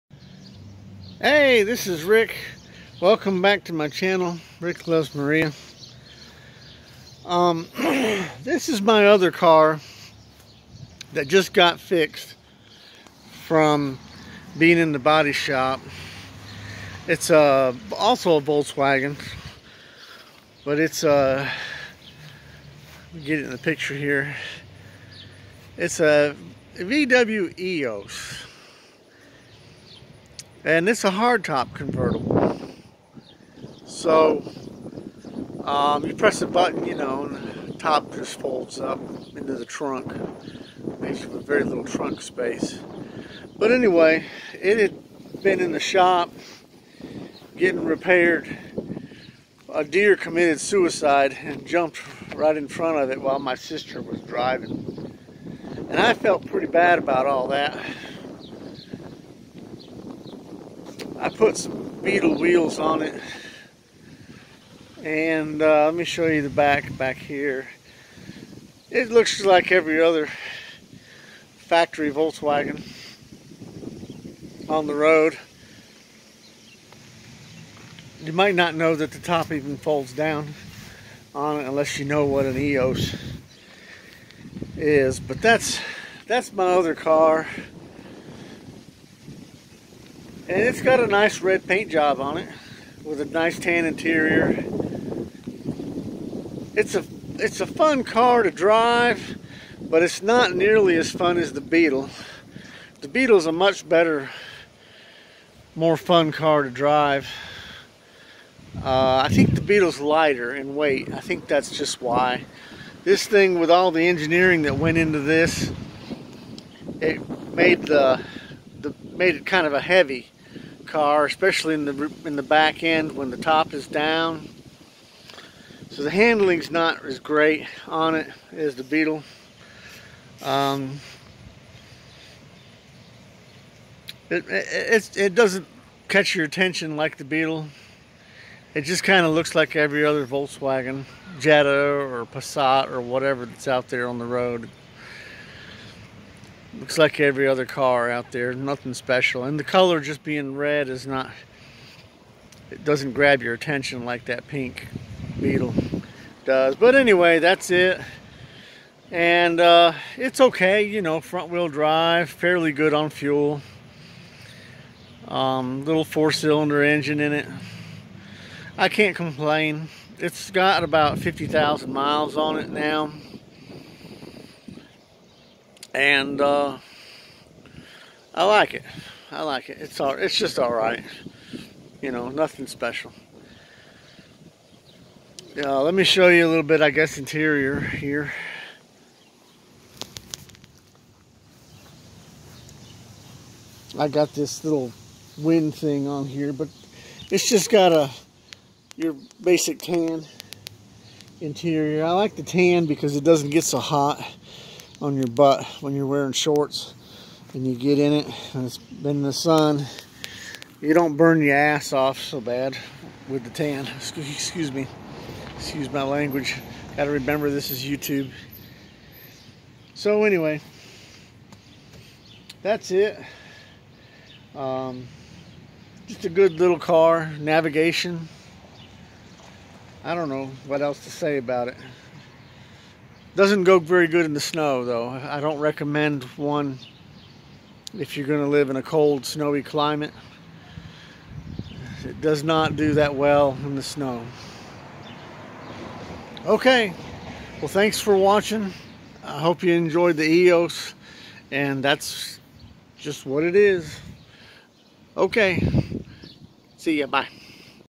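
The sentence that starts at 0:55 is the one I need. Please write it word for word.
And I felt pretty bad about all that.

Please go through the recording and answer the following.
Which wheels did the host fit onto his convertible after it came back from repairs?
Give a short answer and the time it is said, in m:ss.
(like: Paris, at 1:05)
Beetle wheels, at 1:02.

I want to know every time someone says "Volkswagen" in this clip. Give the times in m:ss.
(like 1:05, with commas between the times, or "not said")
0:18, 1:12, 2:20.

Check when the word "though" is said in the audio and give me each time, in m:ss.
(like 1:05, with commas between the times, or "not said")
3:54.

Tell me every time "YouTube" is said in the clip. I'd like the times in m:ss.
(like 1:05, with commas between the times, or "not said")
3:37.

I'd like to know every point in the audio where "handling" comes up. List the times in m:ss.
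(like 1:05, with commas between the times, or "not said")
2:06.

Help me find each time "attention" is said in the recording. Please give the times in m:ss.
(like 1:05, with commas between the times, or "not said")
2:16, 2:33.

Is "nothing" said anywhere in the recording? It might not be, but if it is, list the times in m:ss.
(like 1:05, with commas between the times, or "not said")
2:28, 3:02.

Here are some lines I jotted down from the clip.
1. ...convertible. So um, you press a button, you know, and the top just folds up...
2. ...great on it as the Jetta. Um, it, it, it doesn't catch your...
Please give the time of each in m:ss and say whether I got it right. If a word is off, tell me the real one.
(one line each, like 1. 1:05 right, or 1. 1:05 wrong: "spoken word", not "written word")
1. 0:31 right
2. 2:07 wrong: "Beetle", not "Jetta".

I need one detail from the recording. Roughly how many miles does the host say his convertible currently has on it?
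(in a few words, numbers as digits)
50,000.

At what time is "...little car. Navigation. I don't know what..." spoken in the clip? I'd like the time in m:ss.
3:46.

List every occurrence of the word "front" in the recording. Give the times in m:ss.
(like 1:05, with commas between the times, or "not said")
0:52, 2:41.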